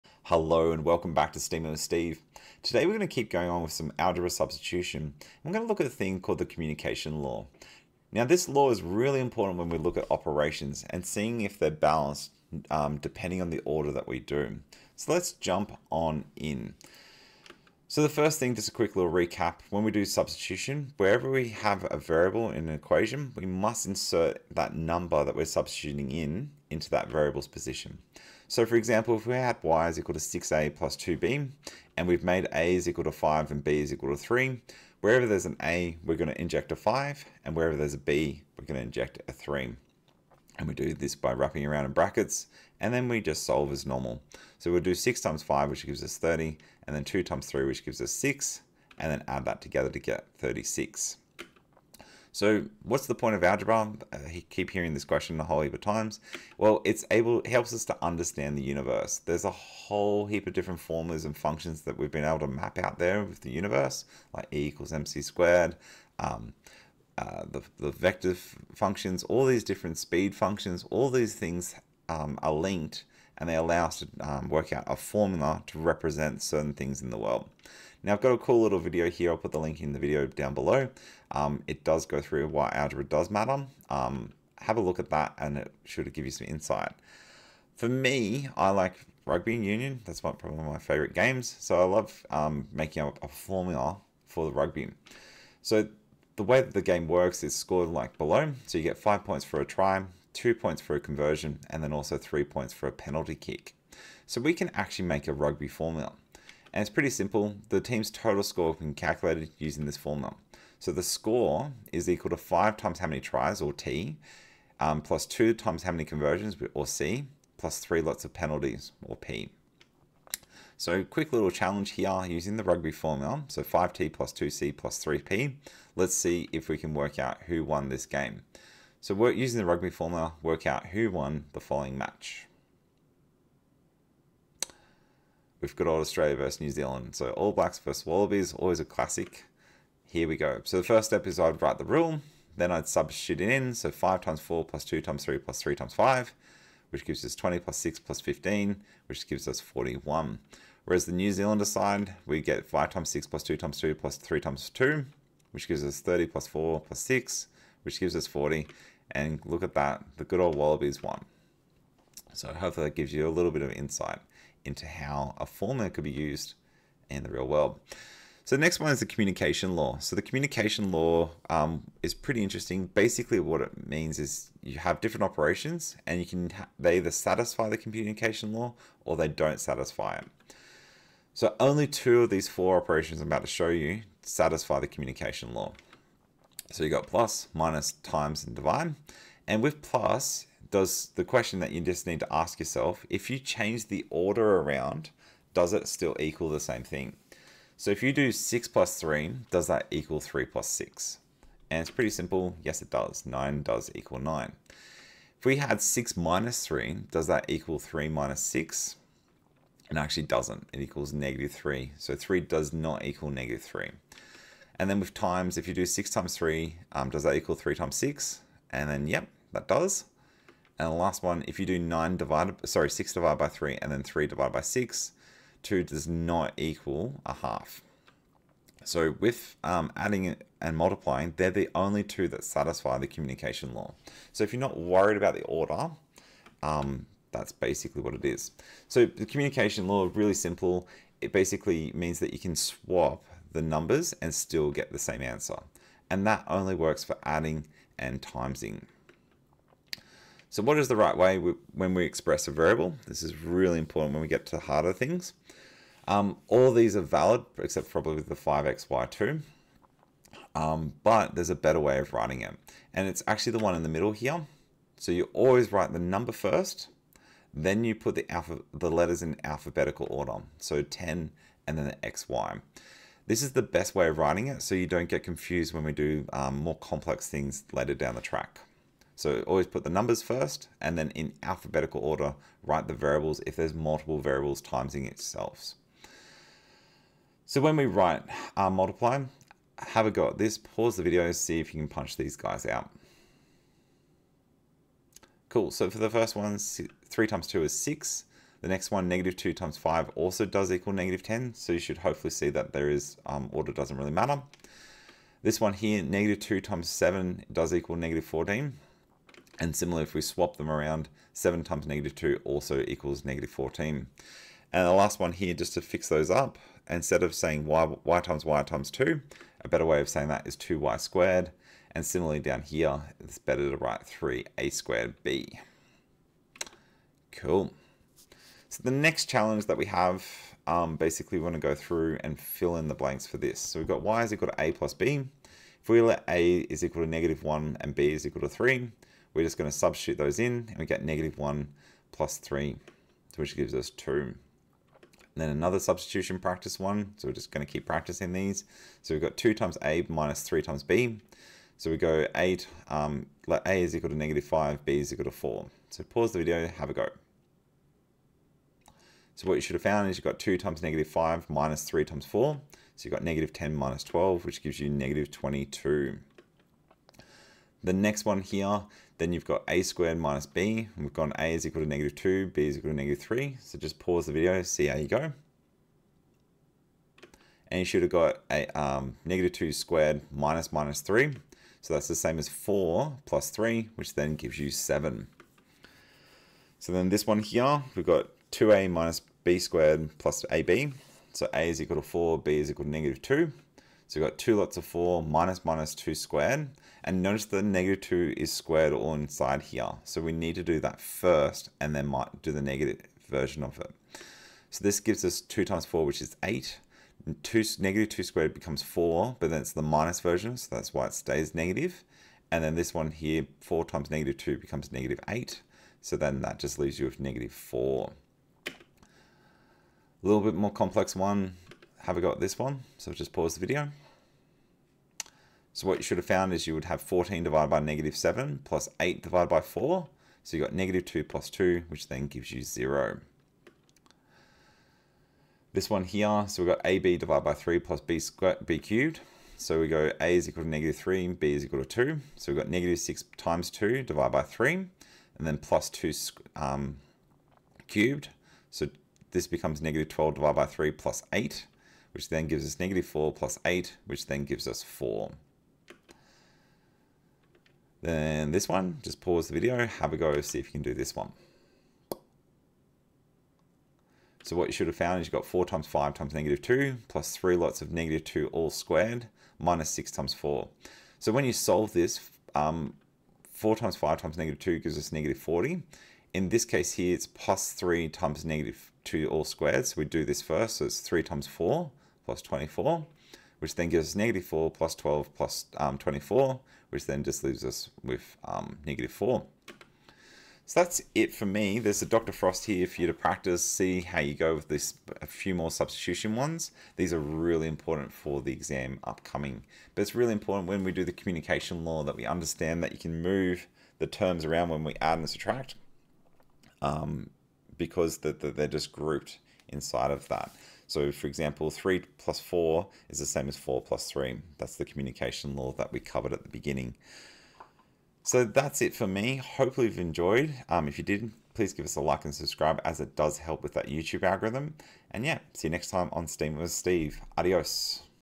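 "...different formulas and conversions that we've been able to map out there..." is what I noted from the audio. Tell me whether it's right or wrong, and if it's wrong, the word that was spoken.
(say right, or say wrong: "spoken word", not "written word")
wrong: "functions", not "conversions".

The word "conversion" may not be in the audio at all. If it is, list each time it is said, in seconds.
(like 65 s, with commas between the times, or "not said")
100 s, 116 s.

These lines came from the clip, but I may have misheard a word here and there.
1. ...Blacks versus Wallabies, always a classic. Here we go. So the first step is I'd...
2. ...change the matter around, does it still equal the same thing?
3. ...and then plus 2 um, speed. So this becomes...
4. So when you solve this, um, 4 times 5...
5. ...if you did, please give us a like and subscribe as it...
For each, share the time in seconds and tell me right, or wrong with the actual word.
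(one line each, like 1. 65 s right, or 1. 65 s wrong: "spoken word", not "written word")
1. 137 s right
2. 193 s wrong: "order", not "matter"
3. 444 s wrong: "cubed", not "speed"
4. 471 s right
5. 520 s right.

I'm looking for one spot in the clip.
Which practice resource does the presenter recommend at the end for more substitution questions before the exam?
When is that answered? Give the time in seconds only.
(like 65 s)
492 s.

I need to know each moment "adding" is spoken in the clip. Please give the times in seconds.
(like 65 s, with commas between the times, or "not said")
229 s, 247 s.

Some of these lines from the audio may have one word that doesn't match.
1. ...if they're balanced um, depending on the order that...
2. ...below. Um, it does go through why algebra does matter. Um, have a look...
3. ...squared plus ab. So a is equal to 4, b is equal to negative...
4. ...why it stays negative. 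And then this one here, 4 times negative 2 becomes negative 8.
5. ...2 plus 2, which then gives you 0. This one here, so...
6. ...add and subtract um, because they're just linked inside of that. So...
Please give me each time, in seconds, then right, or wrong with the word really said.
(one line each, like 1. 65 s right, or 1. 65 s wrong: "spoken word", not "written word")
1. 11 s right
2. 80 s right
3. 389 s right
4. 410 s right
5. 431 s right
6. 505 s wrong: "grouped", not "linked".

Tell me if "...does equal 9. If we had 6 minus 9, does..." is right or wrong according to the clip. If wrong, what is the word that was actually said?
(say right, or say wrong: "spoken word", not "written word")
wrong: "3", not "9".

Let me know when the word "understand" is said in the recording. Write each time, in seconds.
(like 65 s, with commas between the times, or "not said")
58 s, 502 s.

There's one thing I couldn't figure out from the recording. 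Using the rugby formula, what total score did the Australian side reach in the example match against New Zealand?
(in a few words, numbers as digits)
41.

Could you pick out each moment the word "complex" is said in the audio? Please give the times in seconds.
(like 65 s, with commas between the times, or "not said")
276 s, 420 s.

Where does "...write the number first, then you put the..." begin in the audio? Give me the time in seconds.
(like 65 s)
265 s.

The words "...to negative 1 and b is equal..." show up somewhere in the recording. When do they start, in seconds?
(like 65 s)
337 s.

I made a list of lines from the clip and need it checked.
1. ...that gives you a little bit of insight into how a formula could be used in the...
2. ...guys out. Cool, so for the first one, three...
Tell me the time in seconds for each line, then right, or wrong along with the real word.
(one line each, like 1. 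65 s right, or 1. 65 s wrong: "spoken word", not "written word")
1. 162 s right
2. 292 s right.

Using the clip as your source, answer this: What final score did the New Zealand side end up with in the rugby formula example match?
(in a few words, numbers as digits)
40.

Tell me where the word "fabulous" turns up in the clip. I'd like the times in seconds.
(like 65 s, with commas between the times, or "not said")
not said.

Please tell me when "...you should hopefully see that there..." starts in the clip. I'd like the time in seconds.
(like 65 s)
301 s.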